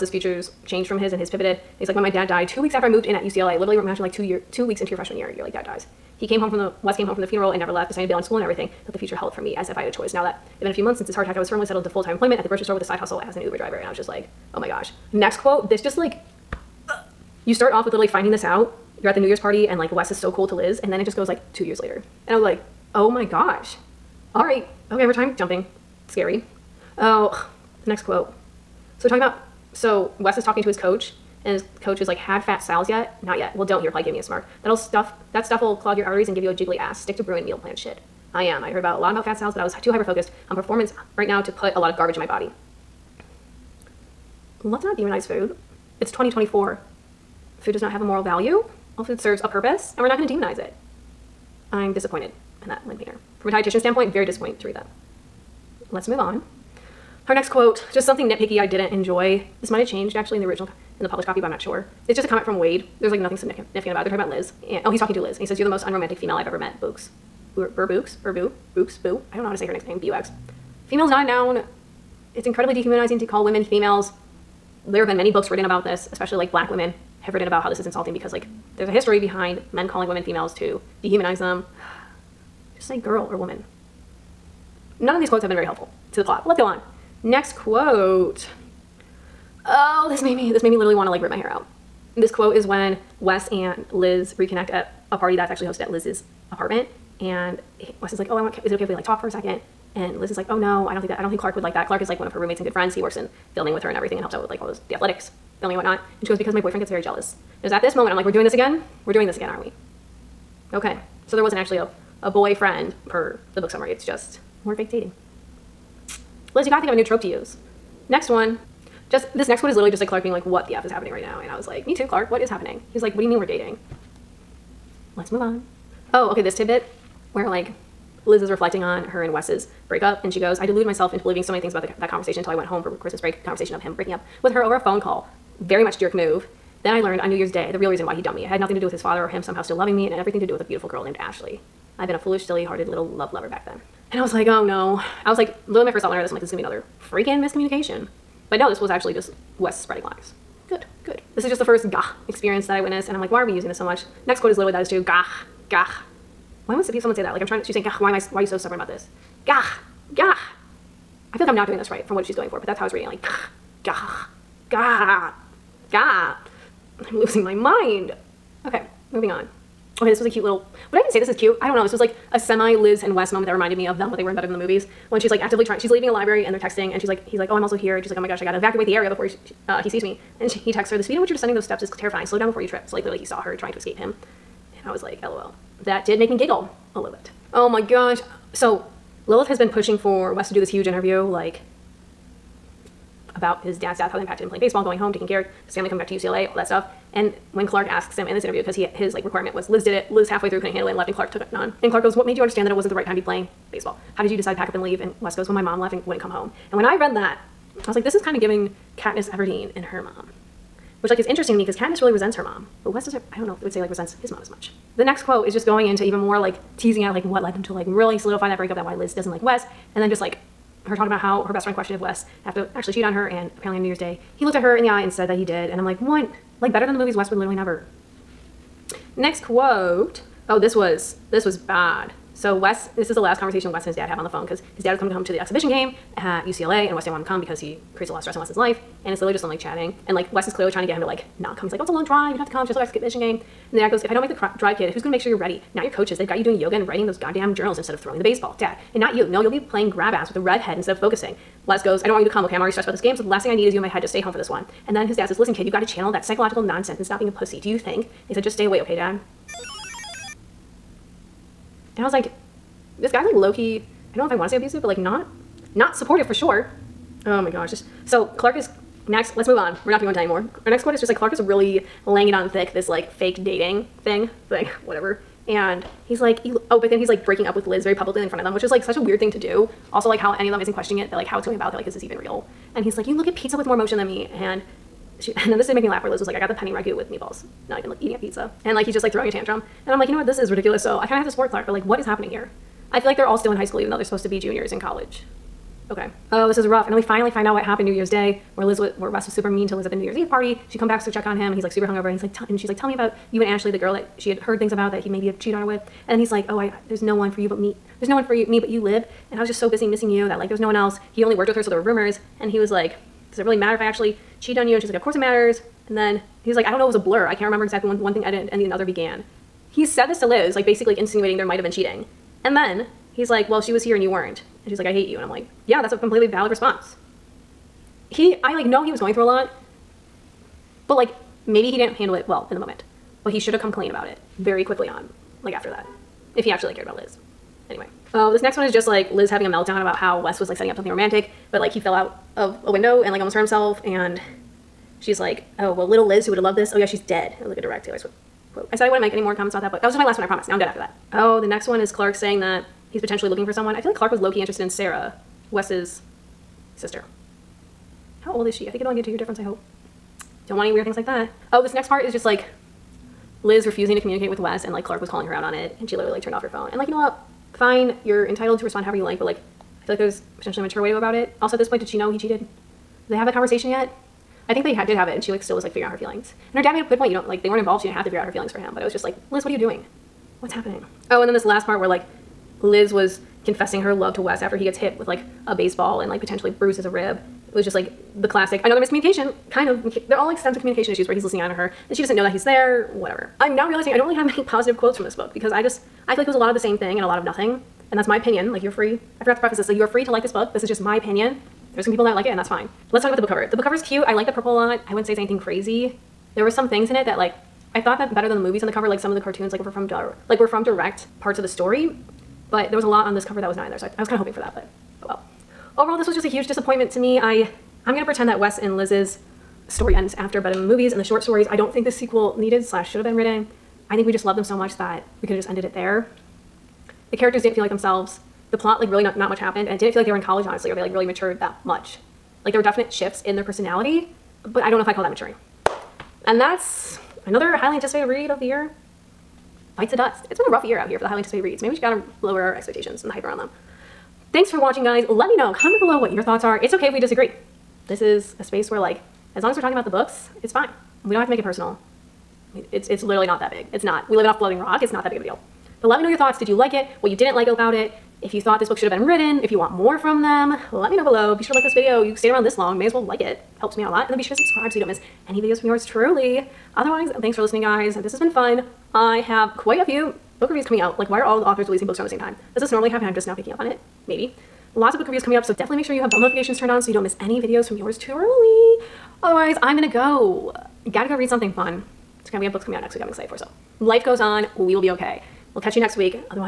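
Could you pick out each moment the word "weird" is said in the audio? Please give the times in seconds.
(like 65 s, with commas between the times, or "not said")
278 s, 360 s.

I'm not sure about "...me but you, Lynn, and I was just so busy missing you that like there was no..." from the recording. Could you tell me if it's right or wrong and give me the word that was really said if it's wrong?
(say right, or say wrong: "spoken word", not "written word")
wrong: "Lib", not "Lynn".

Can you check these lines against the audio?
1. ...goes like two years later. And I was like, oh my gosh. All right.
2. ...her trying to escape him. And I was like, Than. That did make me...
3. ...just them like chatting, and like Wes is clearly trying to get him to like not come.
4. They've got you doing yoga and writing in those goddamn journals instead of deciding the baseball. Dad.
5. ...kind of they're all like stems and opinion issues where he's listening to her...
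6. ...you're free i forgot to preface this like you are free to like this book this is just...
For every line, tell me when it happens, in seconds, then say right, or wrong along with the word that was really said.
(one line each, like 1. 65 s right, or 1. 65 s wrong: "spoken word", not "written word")
1. 21 s right
2. 183 s wrong: "LOL", not "Than"
3. 239 s right
4. 246 s wrong: "throwing", not "deciding"
5. 389 s wrong: "communication", not "opinion"
6. 398 s right.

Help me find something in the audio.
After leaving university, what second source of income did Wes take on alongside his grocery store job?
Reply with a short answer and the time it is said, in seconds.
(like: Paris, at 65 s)
Uber driver, at 13 s.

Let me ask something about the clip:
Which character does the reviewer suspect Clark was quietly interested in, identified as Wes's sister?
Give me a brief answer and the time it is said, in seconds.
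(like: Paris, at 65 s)
Sarah, at 354 s.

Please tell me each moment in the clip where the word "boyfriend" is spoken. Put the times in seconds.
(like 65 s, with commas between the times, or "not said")
106 s, 112 s.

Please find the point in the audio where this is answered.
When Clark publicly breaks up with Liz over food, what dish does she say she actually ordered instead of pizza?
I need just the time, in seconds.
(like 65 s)
286 s.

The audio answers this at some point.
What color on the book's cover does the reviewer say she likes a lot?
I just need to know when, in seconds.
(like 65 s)
404 s.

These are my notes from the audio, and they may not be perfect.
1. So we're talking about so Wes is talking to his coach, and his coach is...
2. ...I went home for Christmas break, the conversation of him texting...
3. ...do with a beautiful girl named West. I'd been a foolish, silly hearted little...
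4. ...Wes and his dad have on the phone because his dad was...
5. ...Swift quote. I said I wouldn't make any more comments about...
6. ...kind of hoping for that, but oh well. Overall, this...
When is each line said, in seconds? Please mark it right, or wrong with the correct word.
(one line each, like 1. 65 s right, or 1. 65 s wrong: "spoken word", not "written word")
1. 28 s right
2. 132 s wrong: "breaking", not "texting"
3. 140 s wrong: "Ashley", not "West"
4. 233 s right
5. 347 s right
6. 414 s right.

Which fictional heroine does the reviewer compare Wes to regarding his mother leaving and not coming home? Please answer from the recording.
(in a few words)
Katniss Everdeen.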